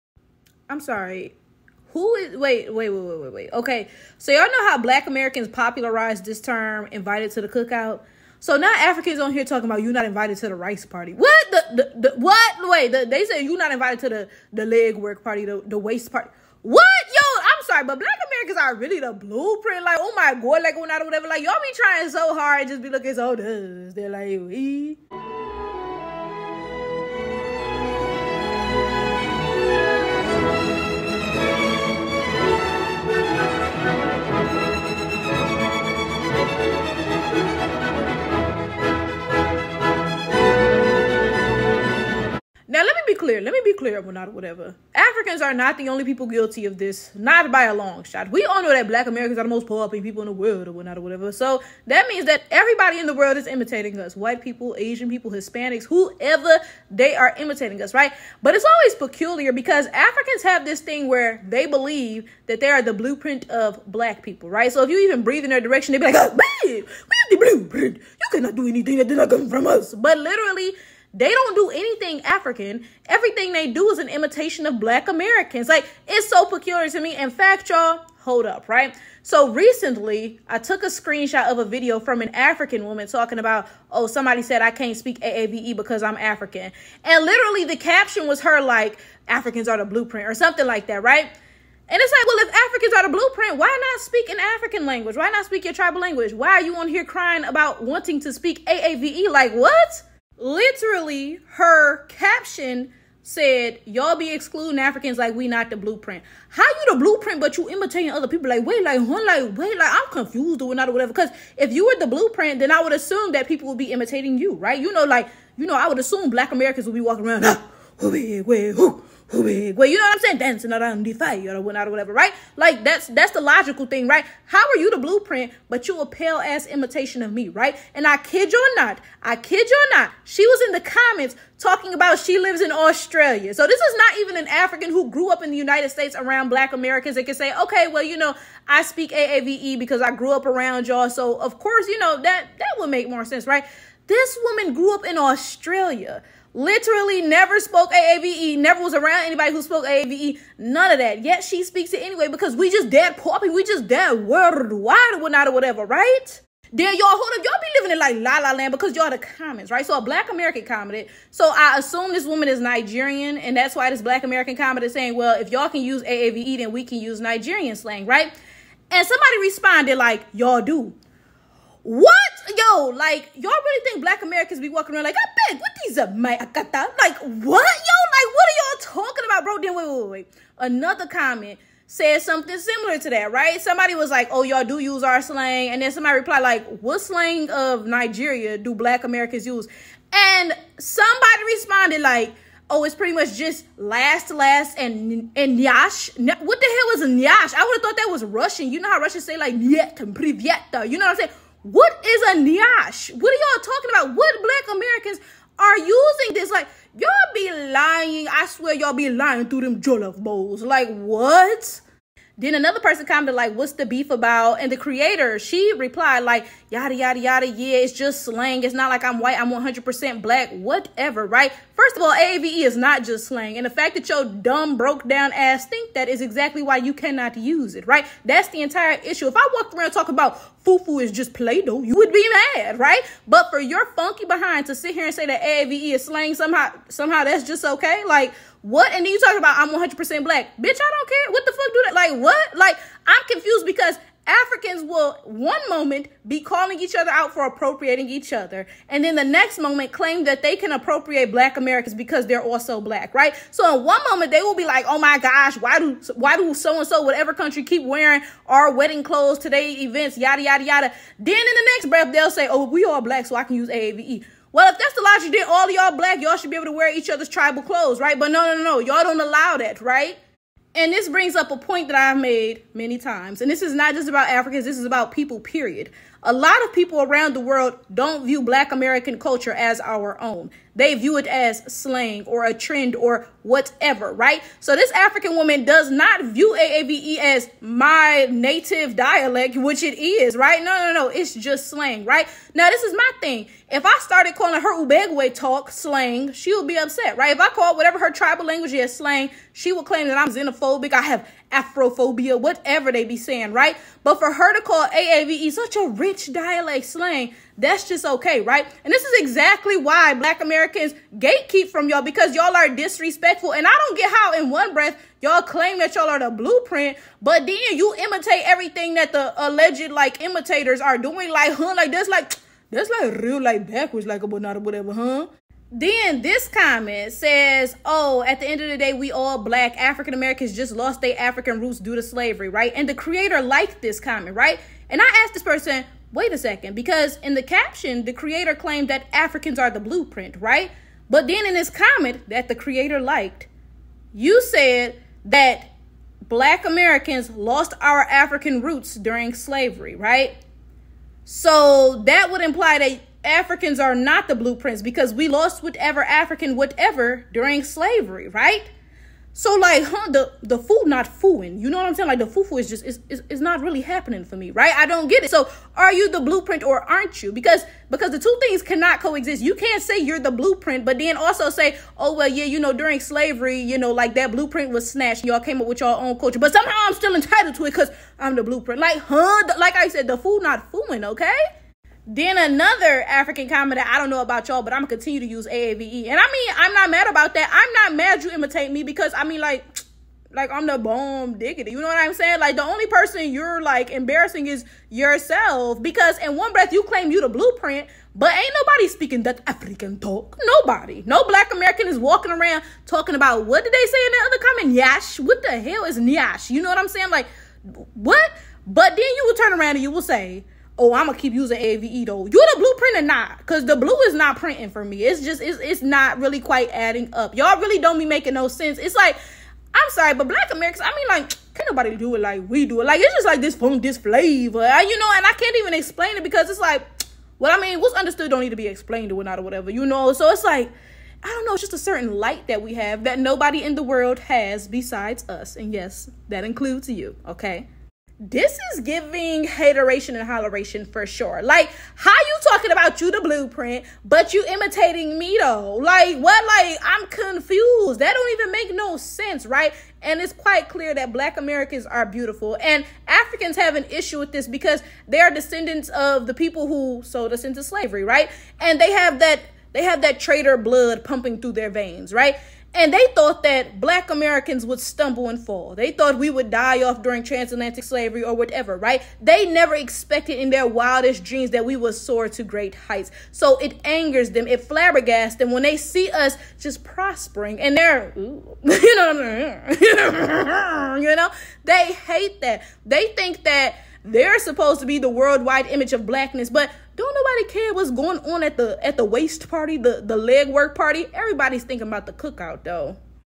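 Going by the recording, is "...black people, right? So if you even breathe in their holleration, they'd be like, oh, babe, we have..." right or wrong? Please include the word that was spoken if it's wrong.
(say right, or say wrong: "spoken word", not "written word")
wrong: "direction", not "holleration".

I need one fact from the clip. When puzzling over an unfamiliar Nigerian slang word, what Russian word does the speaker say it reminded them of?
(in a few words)
nyet.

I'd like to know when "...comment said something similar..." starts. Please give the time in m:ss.
3:01.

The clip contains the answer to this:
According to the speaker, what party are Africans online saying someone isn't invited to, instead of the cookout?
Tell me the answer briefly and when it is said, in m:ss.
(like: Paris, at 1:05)
rice party, at 0:10.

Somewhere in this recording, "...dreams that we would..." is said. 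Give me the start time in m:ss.
7:51.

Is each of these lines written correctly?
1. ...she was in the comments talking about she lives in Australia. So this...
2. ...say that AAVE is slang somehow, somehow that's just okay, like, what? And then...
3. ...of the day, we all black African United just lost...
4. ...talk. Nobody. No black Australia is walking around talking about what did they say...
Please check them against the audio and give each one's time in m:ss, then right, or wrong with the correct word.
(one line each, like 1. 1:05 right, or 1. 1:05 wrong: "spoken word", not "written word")
1. 2:10 right
2. 3:55 right
3. 5:28 wrong: "Americans", not "United"
4. 6:39 wrong: "American", not "Australia".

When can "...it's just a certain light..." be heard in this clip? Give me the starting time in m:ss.
7:11.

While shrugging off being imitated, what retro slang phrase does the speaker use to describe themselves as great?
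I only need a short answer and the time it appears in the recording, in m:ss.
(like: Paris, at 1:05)
bomb diggity, at 6:30.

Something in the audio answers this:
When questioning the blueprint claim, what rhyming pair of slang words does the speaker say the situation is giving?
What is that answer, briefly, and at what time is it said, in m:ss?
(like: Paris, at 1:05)
hateration and holleration, at 7:19.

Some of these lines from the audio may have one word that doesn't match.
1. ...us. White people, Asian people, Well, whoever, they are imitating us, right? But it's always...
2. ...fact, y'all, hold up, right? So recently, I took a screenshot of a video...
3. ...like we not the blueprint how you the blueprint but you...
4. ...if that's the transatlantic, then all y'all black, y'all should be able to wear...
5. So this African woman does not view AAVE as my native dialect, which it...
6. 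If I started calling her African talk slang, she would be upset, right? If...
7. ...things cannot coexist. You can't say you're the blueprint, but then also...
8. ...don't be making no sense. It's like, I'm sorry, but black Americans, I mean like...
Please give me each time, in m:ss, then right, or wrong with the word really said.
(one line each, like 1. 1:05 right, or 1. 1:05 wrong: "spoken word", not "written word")
1. 0:53 wrong: "Hispanics", not "Well"
2. 1:17 right
3. 1:45 right
4. 4:24 wrong: "logic", not "transatlantic"
5. 4:44 right
6. 4:53 wrong: "Ubegwe", not "African"
7. 6:08 right
8. 6:57 right.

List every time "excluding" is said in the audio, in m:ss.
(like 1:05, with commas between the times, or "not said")
1:44.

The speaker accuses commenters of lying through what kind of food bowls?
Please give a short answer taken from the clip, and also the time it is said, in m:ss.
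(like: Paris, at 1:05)
jollof bowls, at 3:29.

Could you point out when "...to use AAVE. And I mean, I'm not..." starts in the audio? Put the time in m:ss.
6:25.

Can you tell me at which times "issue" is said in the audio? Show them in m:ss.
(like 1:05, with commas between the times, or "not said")
3:49, 7:33.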